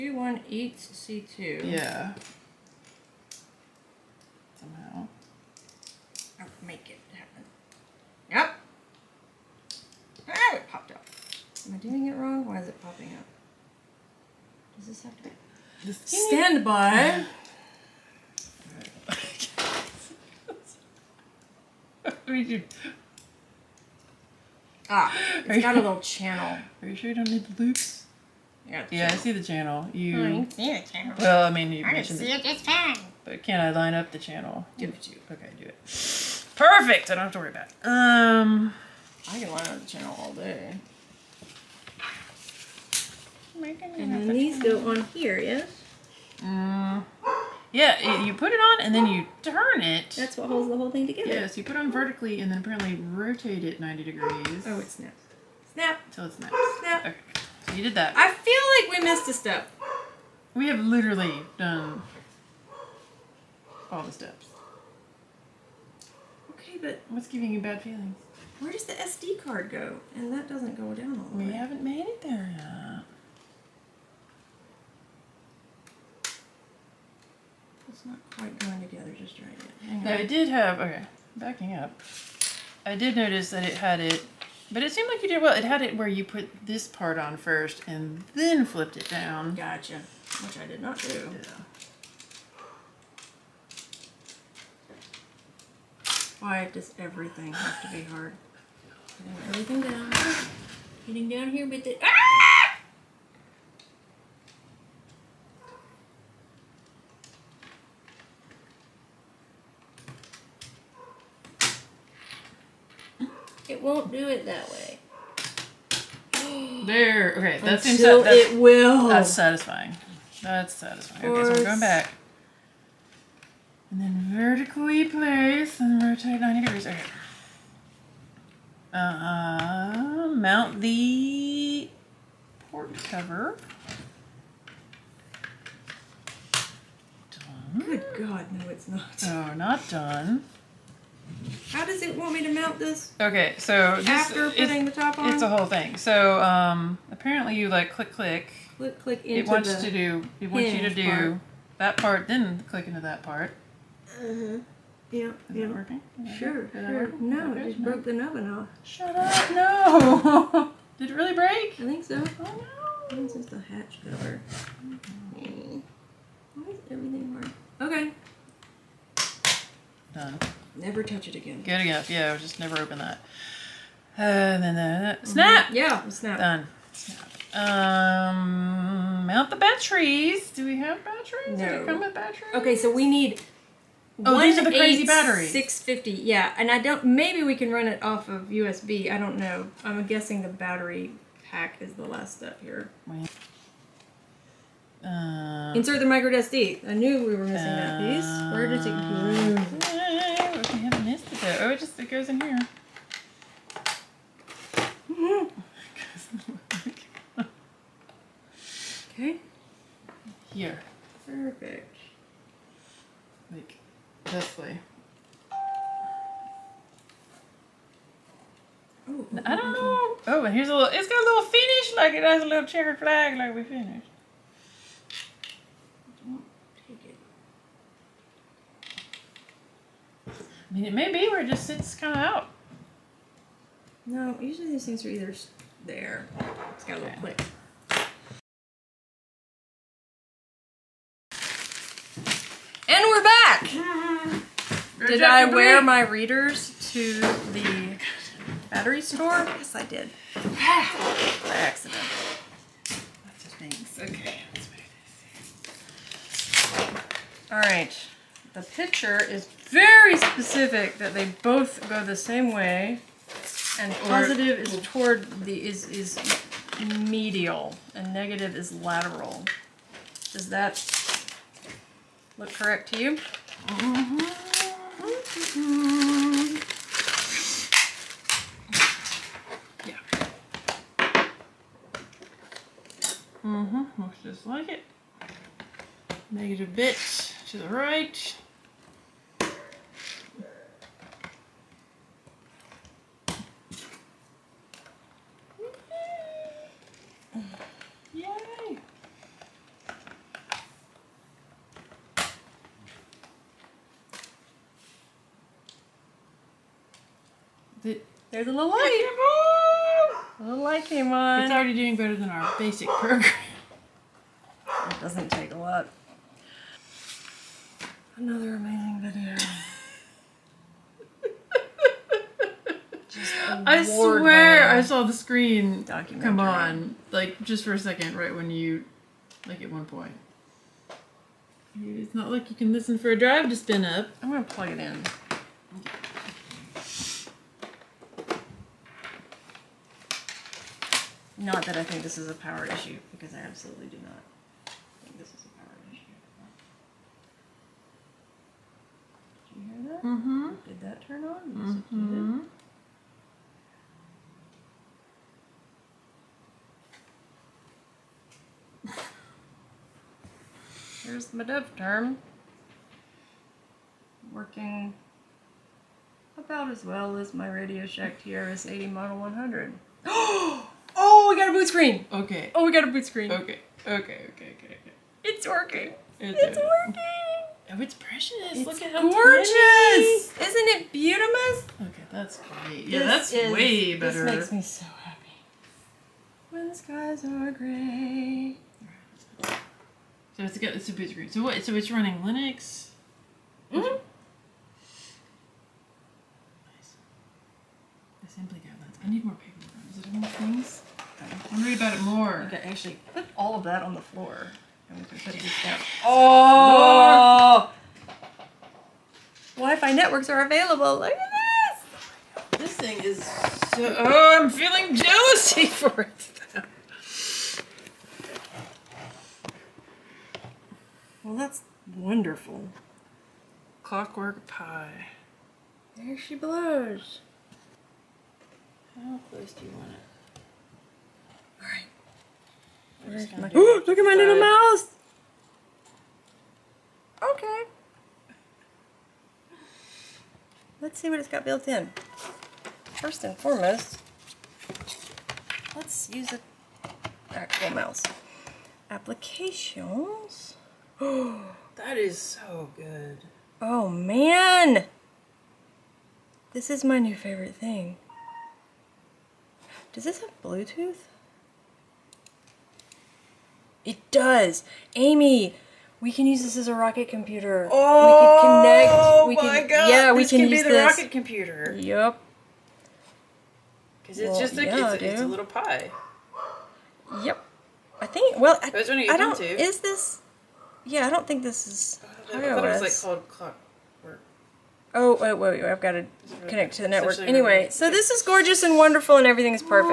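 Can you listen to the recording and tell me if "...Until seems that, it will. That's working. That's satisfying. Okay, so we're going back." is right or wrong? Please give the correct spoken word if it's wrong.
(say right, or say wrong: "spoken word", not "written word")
wrong: "satisfying", not "working".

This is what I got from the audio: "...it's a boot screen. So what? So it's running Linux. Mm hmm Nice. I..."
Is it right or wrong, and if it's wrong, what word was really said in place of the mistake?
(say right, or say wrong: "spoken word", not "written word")
right.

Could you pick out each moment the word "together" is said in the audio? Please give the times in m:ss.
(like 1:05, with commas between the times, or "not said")
0:51, 1:18.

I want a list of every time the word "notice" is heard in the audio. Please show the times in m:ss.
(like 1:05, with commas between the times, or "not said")
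1:23.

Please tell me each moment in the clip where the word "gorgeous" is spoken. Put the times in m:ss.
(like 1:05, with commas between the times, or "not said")
6:19, 8:08.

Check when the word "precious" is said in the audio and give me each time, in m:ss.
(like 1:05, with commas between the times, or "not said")
6:17.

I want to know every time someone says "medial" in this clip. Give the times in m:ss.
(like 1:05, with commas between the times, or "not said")
4:27.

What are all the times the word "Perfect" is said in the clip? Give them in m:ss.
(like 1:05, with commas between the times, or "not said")
0:36, 3:31.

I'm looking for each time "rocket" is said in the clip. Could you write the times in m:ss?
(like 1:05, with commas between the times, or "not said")
7:46, 7:50.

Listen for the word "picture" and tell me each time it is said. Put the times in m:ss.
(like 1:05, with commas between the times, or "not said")
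4:18.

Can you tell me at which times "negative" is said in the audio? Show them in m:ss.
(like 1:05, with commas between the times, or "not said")
4:28, 4:46.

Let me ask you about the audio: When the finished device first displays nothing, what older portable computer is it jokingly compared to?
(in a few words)
Radio Shack TRS-80 Model 100.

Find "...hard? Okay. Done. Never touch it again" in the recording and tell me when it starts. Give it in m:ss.
2:47.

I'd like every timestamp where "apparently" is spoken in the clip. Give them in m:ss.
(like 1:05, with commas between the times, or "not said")
0:52, 2:27.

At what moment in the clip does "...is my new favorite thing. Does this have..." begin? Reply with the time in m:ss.
7:36.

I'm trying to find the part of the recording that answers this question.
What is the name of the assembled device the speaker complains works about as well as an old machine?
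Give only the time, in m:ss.
6:01.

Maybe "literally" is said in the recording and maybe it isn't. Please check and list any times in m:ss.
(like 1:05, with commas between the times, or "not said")
1:00.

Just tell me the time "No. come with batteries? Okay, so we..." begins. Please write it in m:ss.
3:01.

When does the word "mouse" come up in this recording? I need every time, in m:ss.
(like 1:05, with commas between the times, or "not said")
7:14, 7:27.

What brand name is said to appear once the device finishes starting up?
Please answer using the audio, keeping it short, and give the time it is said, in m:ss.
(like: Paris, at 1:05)
Clockwork Pi, at 7:03.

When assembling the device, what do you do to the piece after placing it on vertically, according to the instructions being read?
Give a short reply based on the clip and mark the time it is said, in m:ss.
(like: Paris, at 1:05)
rotate it 90 degrees, at 0:52.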